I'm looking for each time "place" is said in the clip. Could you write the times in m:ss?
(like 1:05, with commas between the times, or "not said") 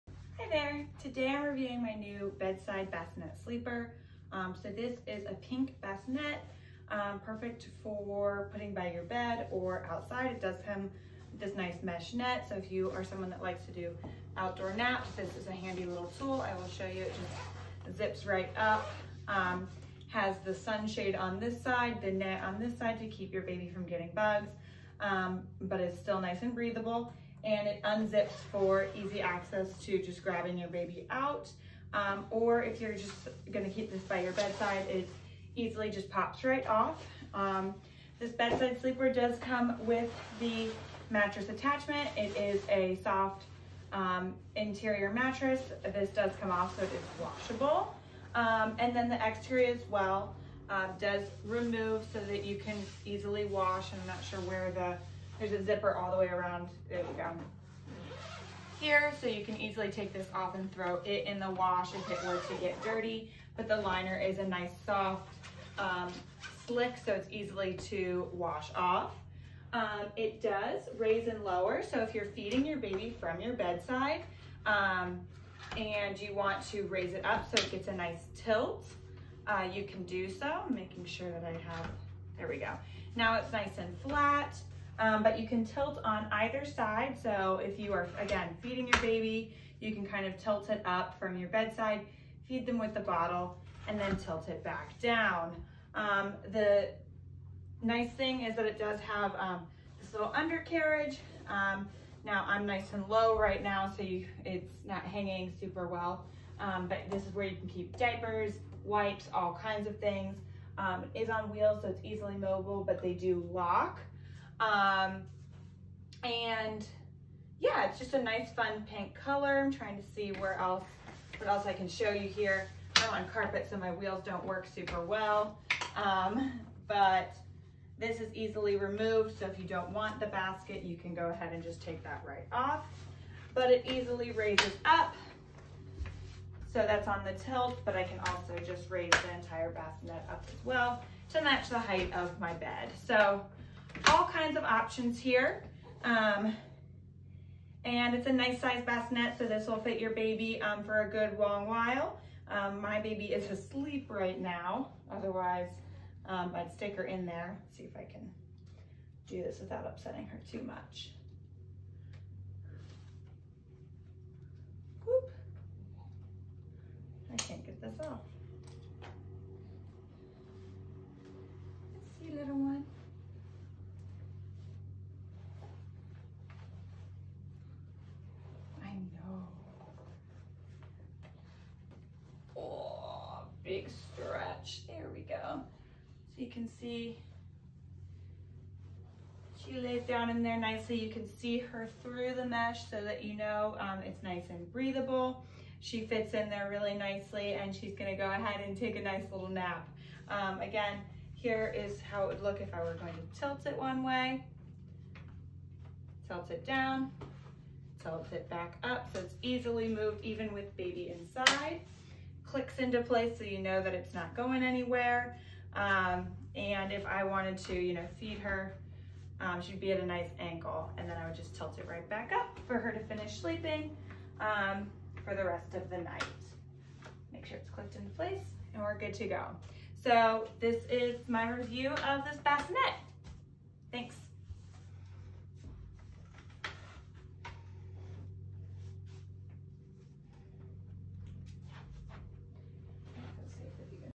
3:33, 3:48.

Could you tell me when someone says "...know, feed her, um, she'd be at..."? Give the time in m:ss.
3:37.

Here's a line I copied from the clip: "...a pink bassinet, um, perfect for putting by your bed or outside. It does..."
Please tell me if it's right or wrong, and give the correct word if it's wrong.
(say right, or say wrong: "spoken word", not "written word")
right.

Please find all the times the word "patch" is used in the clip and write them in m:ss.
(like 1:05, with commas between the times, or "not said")
not said.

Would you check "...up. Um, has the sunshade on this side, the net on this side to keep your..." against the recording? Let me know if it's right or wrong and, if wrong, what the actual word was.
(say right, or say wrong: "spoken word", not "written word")
right.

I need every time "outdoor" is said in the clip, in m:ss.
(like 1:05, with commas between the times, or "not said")
0:14.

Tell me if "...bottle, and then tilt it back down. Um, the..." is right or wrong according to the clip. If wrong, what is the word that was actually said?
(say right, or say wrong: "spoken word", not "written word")
right.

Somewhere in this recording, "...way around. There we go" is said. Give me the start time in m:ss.
0:56.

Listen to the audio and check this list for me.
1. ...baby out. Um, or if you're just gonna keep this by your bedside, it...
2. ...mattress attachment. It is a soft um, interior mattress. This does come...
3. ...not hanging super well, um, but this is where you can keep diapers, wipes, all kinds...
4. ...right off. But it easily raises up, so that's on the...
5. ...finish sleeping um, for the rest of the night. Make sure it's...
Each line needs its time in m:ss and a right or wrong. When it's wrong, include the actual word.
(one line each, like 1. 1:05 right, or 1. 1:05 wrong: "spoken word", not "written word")
1. 0:30 right
2. 0:41 right
3. 1:44 right
4. 2:12 right
5. 3:42 right.